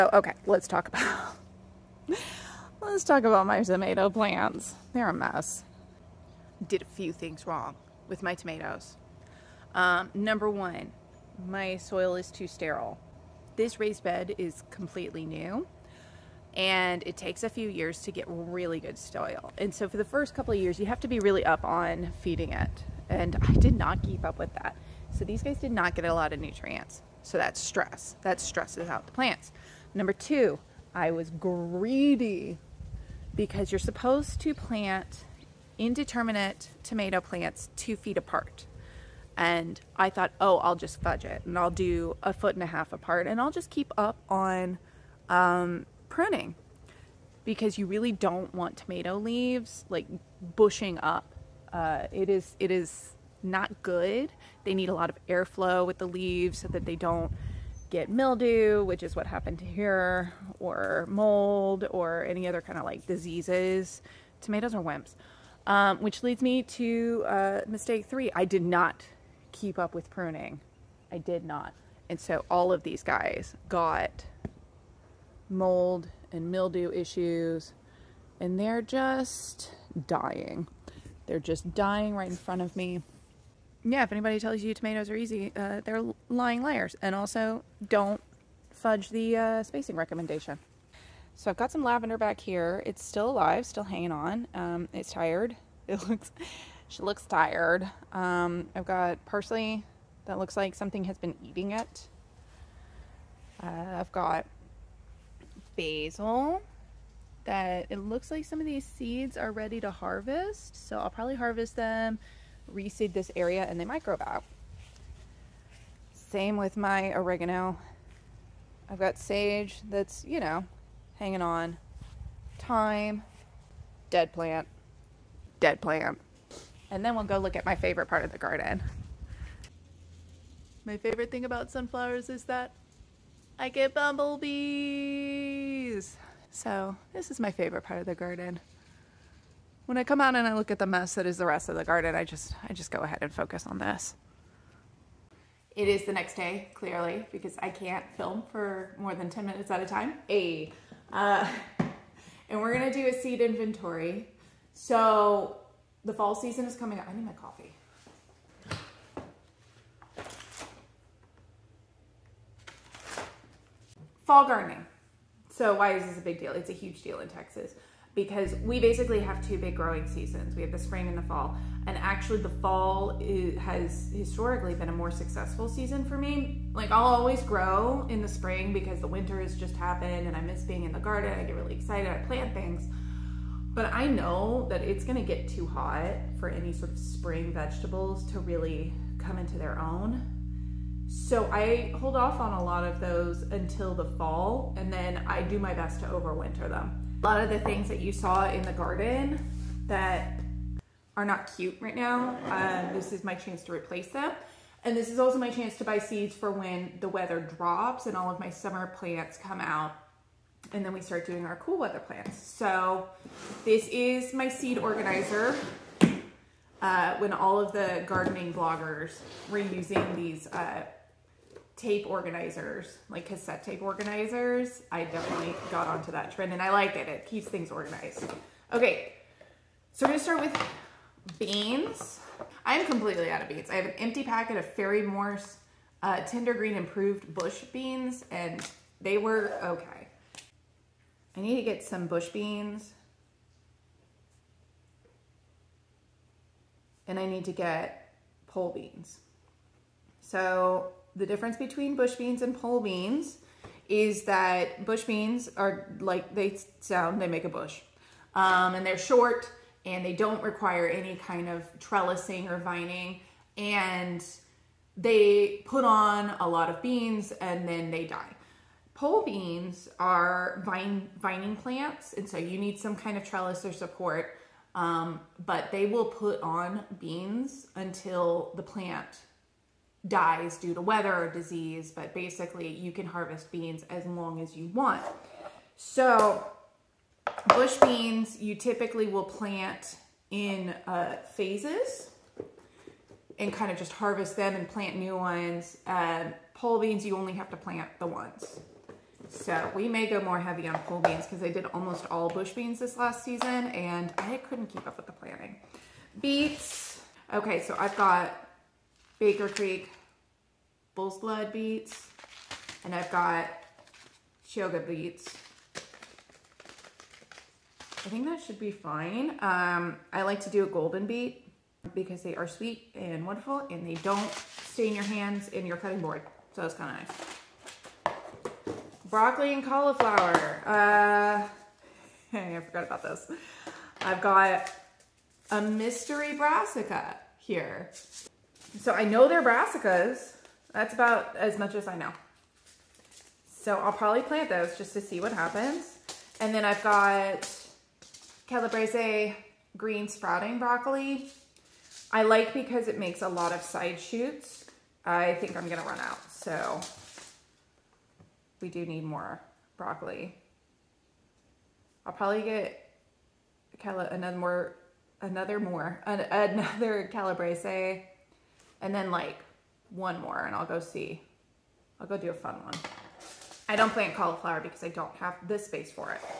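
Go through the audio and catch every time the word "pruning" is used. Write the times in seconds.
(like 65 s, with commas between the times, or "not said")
46 s, 70 s.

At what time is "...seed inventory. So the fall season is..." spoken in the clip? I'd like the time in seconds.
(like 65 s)
153 s.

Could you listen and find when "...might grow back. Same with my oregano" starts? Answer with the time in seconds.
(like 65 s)
113 s.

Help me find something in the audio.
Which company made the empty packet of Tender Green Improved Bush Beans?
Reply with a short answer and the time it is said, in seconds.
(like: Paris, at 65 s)
Ferry-Morse, at 234 s.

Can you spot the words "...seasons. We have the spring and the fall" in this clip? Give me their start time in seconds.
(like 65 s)
170 s.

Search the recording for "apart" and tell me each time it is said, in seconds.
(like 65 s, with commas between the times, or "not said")
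38 s, 42 s.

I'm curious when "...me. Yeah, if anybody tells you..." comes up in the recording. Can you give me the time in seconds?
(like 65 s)
82 s.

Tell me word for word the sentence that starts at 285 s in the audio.
So bush beans, you typically will plant in uh, phases and kind of just harvest them and plant new ones.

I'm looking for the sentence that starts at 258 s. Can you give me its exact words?
Um, and they're short and they don't require any kind of trellising or vining.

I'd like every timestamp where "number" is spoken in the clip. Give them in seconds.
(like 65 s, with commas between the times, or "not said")
10 s, 29 s.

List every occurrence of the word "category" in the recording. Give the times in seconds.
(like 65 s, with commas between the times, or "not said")
not said.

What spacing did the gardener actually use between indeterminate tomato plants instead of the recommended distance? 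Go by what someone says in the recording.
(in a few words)
1.5 feet.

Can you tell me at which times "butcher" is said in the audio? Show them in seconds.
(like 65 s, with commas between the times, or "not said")
not said.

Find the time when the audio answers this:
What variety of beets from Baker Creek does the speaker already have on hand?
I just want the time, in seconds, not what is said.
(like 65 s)
310 s.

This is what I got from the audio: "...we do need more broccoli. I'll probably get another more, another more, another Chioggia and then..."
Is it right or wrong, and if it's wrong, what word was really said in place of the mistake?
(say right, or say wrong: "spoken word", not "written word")
wrong: "Calabrese", not "Chioggia".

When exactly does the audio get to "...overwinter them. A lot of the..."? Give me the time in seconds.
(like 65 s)
196 s.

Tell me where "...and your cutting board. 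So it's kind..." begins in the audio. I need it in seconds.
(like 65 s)
325 s.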